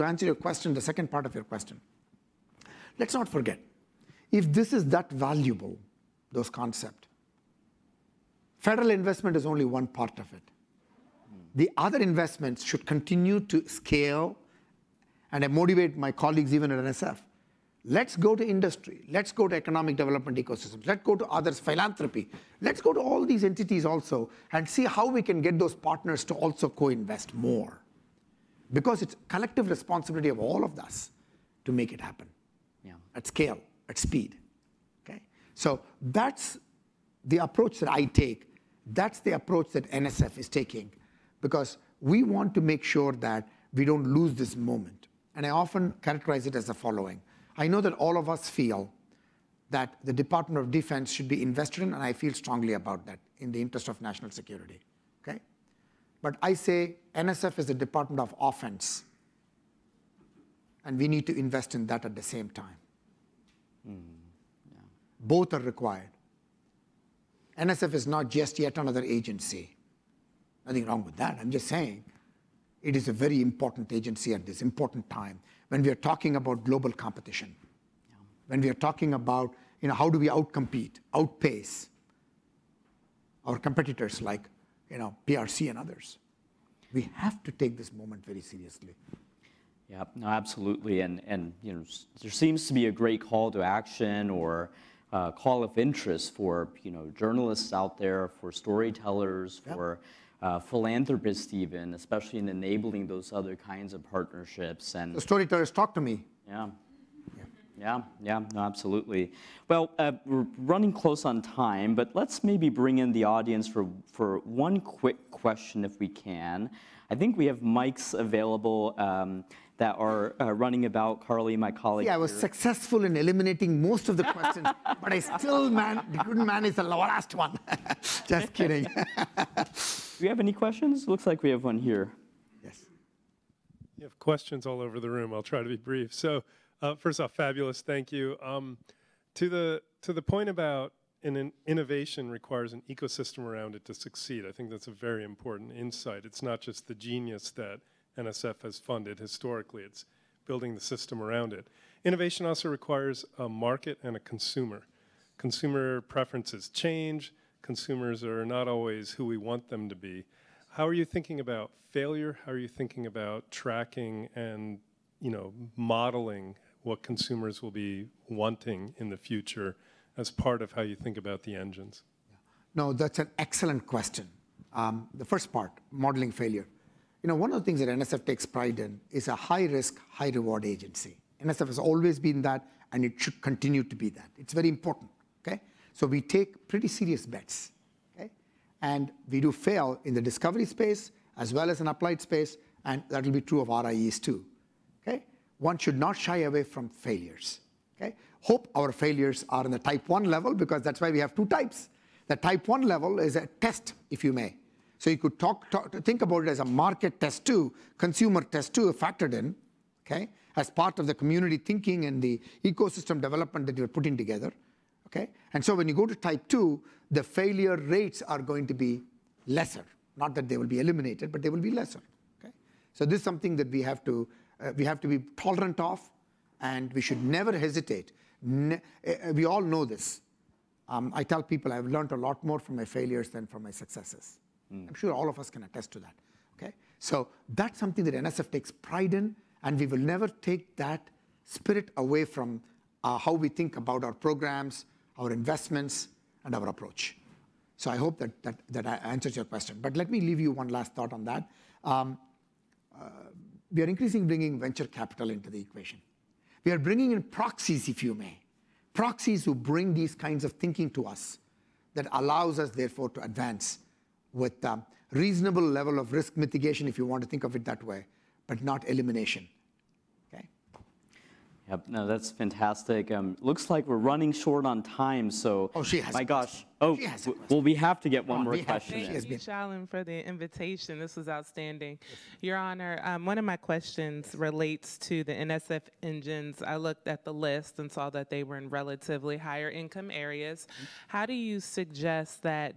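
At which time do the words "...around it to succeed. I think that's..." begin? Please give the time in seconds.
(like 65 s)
143 s.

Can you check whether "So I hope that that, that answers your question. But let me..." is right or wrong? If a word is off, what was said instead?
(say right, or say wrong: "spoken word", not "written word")
right.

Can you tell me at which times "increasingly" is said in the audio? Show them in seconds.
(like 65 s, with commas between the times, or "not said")
253 s.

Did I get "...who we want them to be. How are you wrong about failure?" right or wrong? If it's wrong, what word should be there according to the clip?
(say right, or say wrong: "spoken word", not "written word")
wrong: "thinking", not "wrong".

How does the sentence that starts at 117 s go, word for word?
I think we have mics available.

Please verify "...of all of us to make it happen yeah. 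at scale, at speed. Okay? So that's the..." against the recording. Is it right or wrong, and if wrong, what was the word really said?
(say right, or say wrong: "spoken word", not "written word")
right.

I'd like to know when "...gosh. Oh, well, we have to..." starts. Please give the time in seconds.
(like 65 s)
276 s.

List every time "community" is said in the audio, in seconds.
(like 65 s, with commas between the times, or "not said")
211 s.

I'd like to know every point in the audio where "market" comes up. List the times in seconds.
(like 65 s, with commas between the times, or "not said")
153 s, 206 s.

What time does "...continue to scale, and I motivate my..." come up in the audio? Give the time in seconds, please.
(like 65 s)
12 s.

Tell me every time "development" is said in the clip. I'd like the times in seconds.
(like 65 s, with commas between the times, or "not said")
19 s, 213 s.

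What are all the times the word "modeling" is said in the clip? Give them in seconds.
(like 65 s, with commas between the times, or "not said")
165 s, 175 s.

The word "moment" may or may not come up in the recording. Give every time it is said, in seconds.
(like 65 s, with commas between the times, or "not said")
44 s, 87 s.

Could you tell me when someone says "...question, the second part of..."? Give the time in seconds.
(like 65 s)
0 s.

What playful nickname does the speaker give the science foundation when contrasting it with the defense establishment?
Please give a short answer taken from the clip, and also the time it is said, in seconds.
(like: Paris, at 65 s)
Department of Offense, at 57 s.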